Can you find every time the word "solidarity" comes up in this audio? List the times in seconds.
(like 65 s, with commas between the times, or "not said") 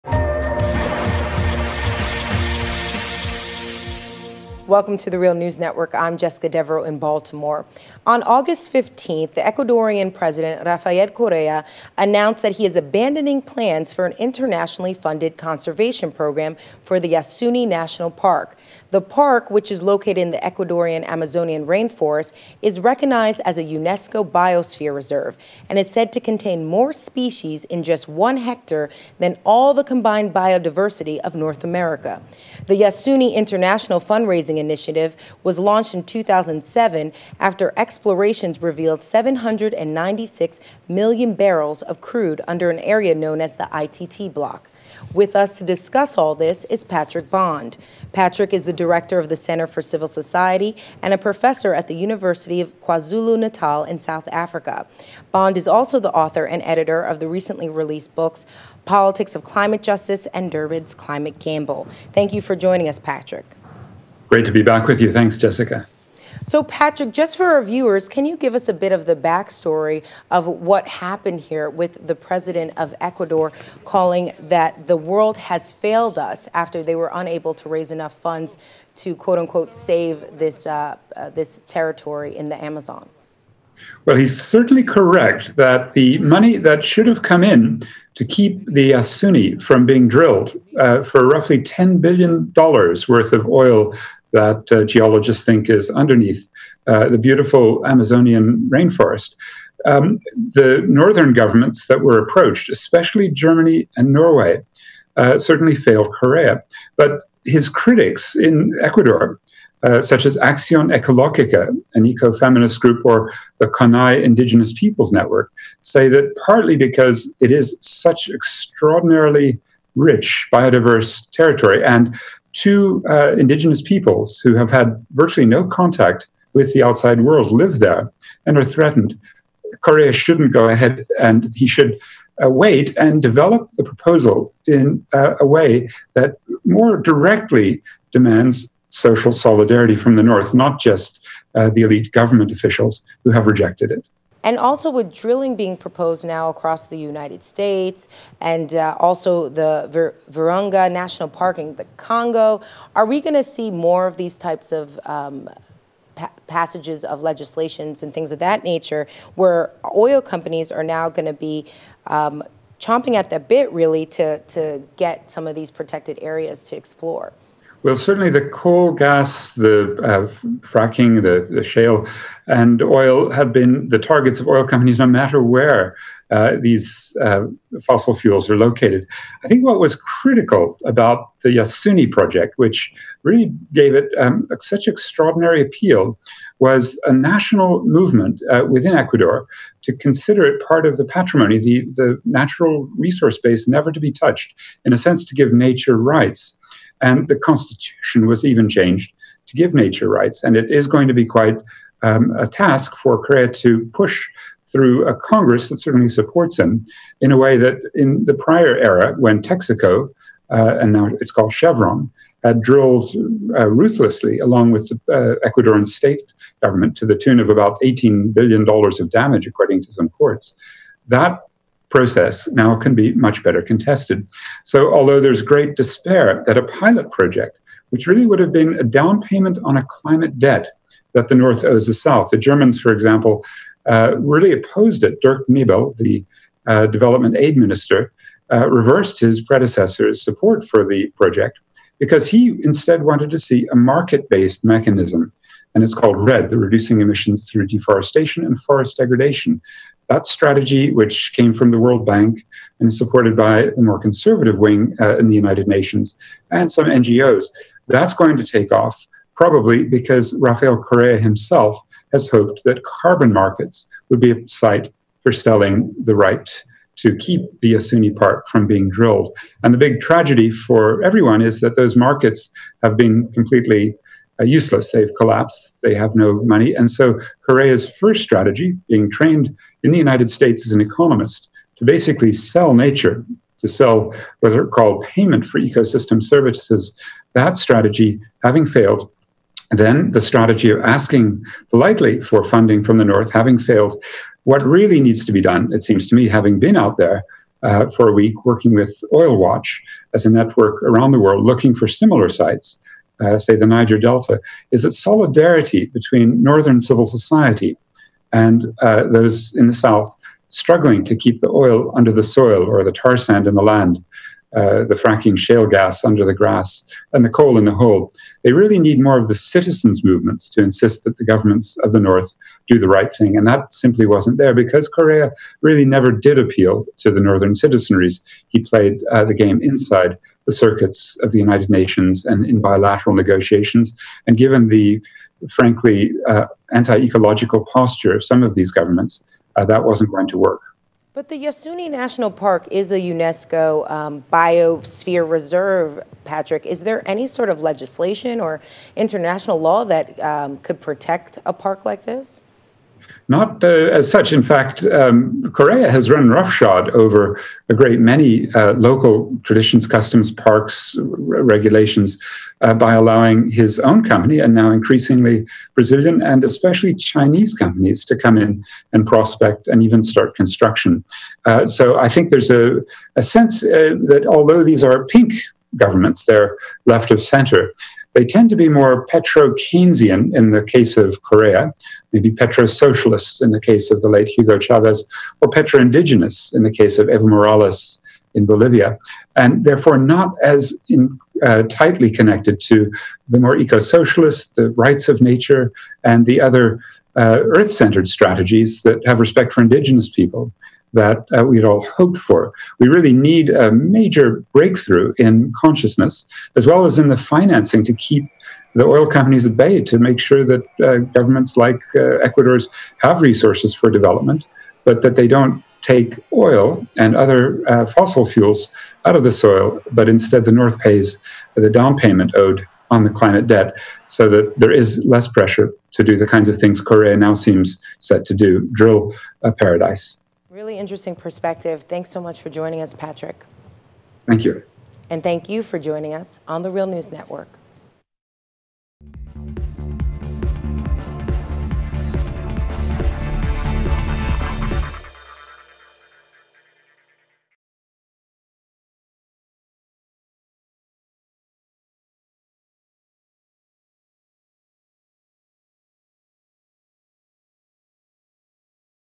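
139 s, 304 s.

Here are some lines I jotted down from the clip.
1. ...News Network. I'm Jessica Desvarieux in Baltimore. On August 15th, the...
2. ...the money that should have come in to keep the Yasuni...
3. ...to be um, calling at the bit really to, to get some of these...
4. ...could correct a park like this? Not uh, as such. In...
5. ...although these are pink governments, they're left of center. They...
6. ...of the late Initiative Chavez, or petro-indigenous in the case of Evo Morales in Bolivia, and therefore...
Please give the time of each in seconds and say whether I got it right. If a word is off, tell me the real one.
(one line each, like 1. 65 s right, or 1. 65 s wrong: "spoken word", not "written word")
1. 5 s right
2. 85 s right
3. 161 s wrong: "chomping", not "calling"
4. 350 s wrong: "protect", not "correct"
5. 374 s right
6. 383 s wrong: "Hugo", not "Initiative".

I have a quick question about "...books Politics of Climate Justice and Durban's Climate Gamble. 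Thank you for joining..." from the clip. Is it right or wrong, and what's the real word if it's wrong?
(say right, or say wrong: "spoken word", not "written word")
right.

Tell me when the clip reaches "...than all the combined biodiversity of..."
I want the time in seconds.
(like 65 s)
29 s.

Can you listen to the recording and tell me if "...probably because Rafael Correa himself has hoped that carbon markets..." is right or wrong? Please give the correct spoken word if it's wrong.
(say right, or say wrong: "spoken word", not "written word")
right.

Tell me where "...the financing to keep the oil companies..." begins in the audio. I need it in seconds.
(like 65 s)
407 s.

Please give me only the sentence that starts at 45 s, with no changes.
With us to discuss all this is Patrick Bond.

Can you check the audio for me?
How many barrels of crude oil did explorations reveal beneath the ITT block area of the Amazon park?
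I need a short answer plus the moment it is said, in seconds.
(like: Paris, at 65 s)
796 million, at 39 s.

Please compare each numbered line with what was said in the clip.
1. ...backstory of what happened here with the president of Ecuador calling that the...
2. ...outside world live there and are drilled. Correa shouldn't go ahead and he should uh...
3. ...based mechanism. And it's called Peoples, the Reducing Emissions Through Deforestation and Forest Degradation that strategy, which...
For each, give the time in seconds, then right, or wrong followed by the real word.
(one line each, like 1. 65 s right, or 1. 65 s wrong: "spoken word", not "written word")
1. 69 s right
2. 126 s wrong: "threatened", not "drilled"
3. 244 s wrong: "REDD", not "Peoples".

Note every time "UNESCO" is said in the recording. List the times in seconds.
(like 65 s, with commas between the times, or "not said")
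23 s, 342 s.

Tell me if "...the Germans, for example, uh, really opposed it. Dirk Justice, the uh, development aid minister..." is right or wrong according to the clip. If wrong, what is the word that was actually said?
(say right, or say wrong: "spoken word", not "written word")
wrong: "Niebel", not "Justice".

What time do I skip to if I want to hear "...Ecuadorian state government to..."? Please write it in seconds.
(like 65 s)
215 s.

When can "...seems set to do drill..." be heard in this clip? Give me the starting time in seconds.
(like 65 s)
427 s.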